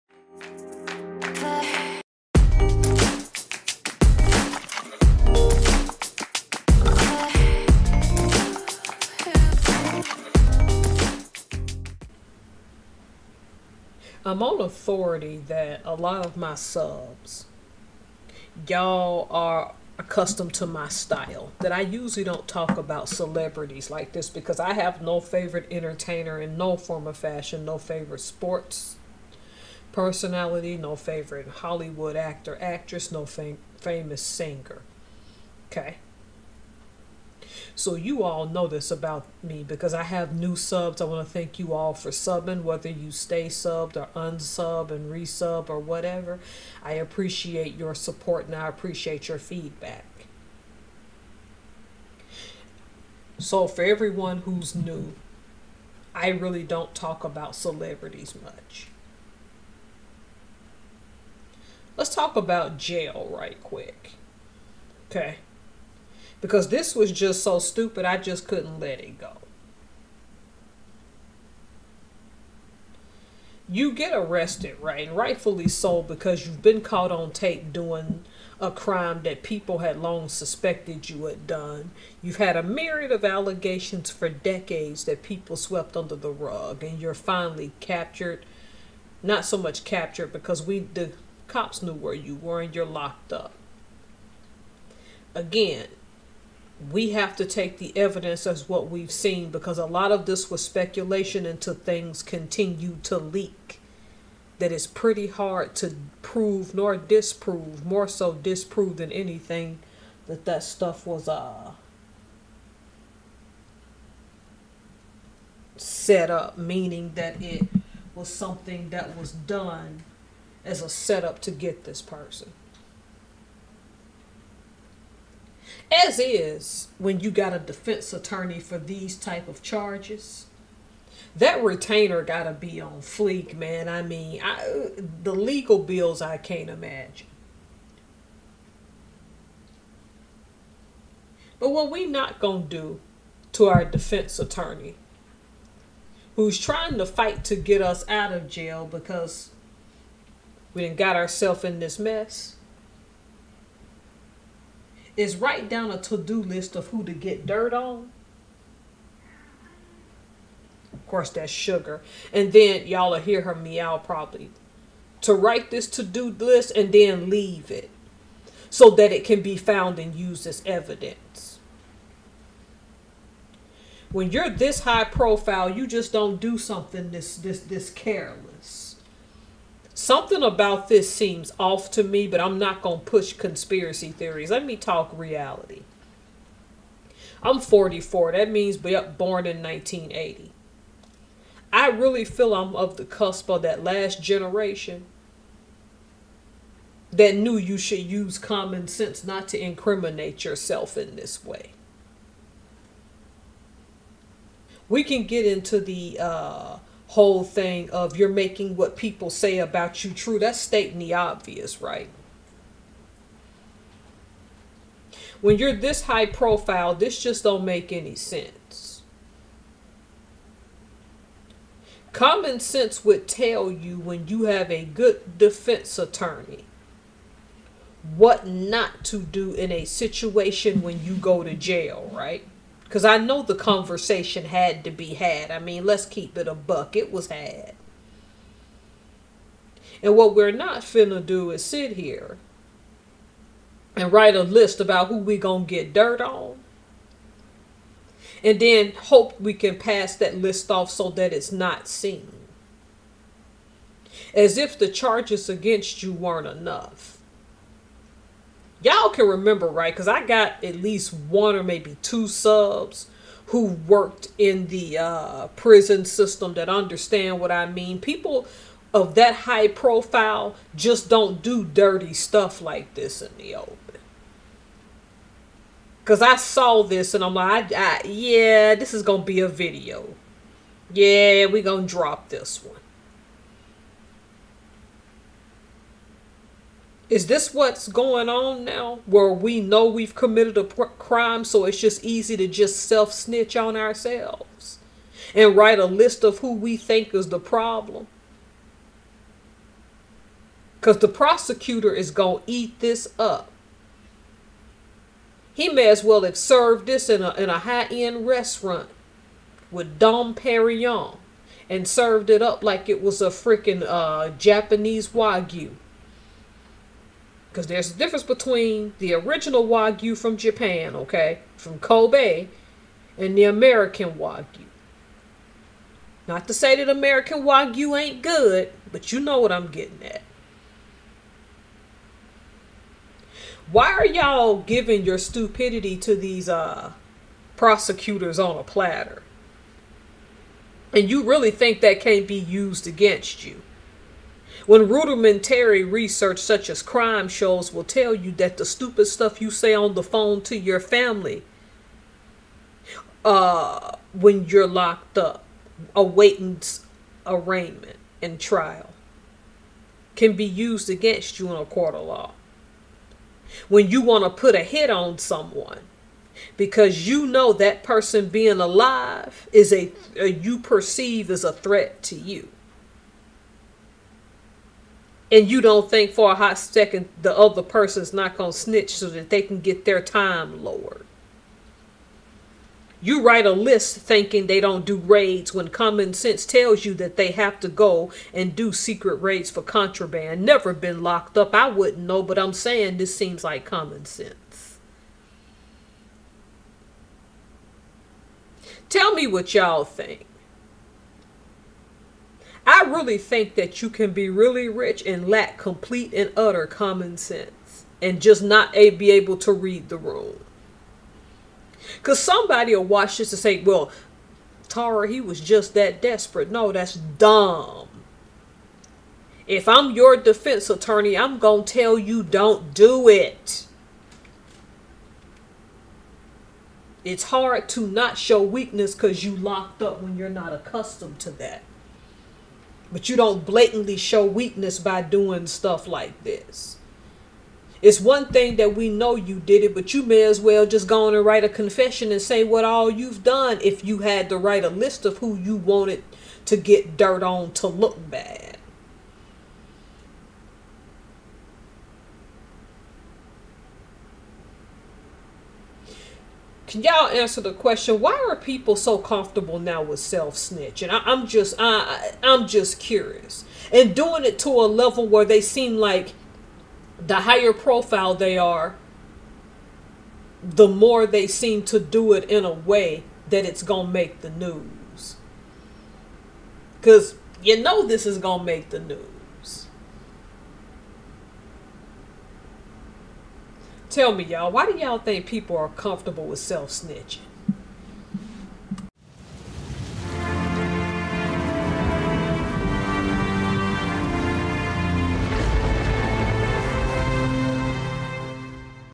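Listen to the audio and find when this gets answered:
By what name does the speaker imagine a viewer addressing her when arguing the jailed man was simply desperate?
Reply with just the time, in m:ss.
6:54.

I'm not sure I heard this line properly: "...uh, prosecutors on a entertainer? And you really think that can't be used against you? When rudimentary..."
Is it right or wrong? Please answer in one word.
wrong.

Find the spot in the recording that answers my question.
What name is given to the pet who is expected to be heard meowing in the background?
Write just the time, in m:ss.
2:41.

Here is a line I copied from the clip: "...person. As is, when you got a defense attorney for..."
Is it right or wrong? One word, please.
right.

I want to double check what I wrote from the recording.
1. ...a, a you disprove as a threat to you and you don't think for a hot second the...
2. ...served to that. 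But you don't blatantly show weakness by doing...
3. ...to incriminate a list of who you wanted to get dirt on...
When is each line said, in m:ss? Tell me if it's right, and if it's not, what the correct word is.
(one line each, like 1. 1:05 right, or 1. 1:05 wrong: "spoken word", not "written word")
1. 6:09 wrong: "perceive", not "disprove"
2. 7:10 wrong: "accustomed", not "served"
3. 7:24 wrong: "write", not "incriminate".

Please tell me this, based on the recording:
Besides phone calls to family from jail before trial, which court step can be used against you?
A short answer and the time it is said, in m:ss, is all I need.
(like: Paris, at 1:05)
arraignment, at 5:57.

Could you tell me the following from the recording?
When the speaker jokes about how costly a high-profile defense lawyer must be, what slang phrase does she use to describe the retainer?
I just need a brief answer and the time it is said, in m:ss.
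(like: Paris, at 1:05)
on fleek, at 2:12.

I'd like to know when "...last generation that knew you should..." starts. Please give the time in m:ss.
3:13.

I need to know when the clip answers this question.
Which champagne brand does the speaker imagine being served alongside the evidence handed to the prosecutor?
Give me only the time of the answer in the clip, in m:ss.
5:09.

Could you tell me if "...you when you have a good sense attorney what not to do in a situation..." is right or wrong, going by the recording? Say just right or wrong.
wrong.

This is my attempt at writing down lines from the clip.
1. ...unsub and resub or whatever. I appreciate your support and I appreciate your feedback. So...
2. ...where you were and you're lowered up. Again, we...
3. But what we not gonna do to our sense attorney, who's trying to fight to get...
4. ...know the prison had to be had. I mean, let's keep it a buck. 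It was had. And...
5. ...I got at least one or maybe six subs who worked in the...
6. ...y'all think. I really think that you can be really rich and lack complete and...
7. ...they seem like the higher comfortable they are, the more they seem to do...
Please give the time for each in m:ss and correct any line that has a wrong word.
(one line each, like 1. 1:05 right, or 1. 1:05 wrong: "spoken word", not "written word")
1. 0:44 right
2. 1:31 wrong: "locked", not "lowered"
3. 2:21 wrong: "defense", not "sense"
4. 3:53 wrong: "conversation", not "prison"
5. 4:20 wrong: "two", not "six"
6. 6:39 right
7. 7:45 wrong: "profile", not "comfortable".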